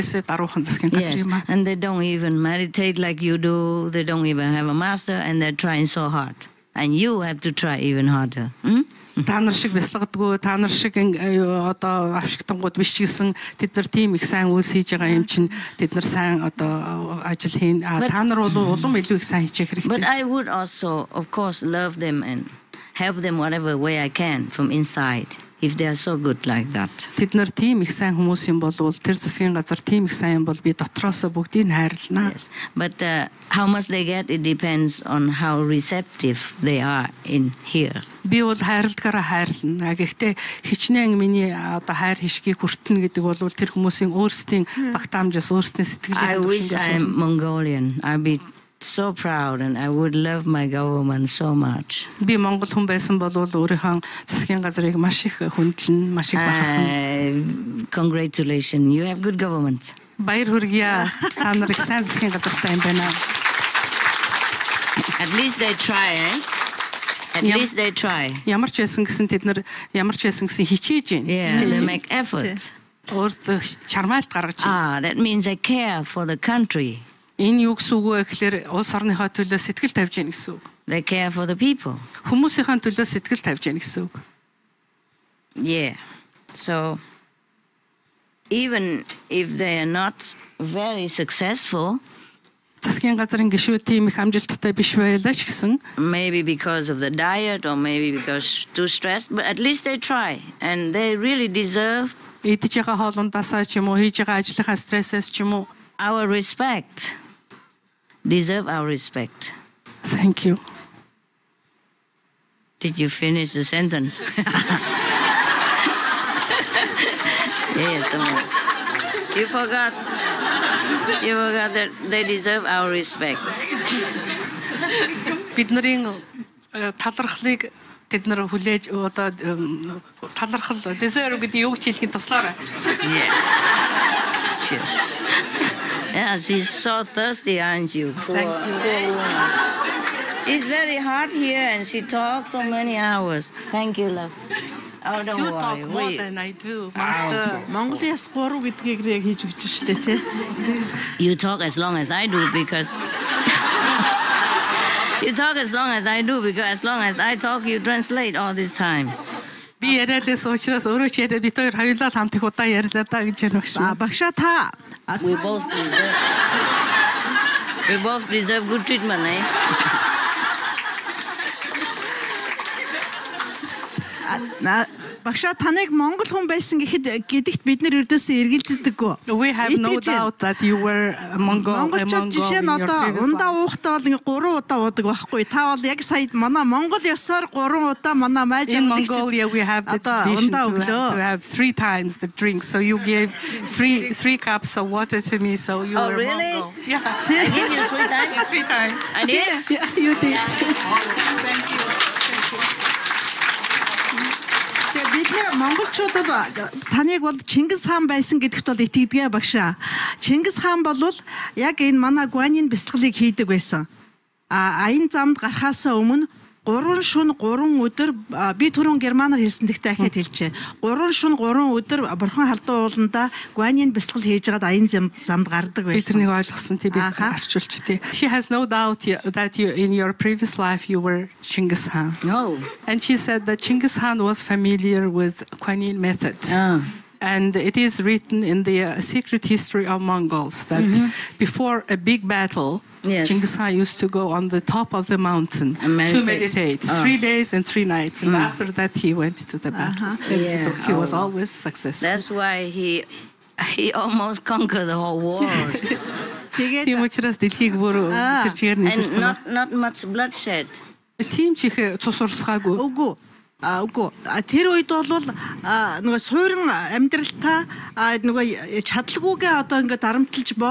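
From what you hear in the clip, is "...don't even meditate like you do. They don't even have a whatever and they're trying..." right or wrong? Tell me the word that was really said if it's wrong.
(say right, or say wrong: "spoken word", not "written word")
wrong: "master", not "whatever".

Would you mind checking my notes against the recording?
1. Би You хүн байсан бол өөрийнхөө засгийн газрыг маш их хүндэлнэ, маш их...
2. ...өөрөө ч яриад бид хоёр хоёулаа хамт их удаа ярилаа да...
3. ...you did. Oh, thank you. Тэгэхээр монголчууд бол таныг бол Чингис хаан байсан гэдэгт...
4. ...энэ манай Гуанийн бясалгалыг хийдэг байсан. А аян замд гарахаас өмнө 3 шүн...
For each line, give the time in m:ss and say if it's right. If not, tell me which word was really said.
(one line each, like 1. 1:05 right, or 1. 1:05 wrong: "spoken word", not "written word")
1. 0:52 wrong: "Монгол", not "You"
2. 2:40 right
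3. 3:19 right
4. 3:31 right.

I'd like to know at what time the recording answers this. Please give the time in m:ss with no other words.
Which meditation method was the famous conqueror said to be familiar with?
3:55.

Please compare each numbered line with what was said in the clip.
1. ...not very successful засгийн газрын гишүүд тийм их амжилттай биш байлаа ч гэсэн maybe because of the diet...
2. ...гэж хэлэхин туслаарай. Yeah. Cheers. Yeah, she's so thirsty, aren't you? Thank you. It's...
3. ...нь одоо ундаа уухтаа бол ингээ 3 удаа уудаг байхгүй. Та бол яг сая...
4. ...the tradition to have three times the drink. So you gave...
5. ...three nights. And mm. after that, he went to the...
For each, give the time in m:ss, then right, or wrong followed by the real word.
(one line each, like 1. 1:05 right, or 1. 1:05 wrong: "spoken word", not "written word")
1. 1:29 right
2. 2:11 right
3. 3:02 right
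4. 3:09 right
5. 4:07 right.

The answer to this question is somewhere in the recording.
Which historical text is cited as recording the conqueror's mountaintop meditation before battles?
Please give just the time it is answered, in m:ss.
3:59.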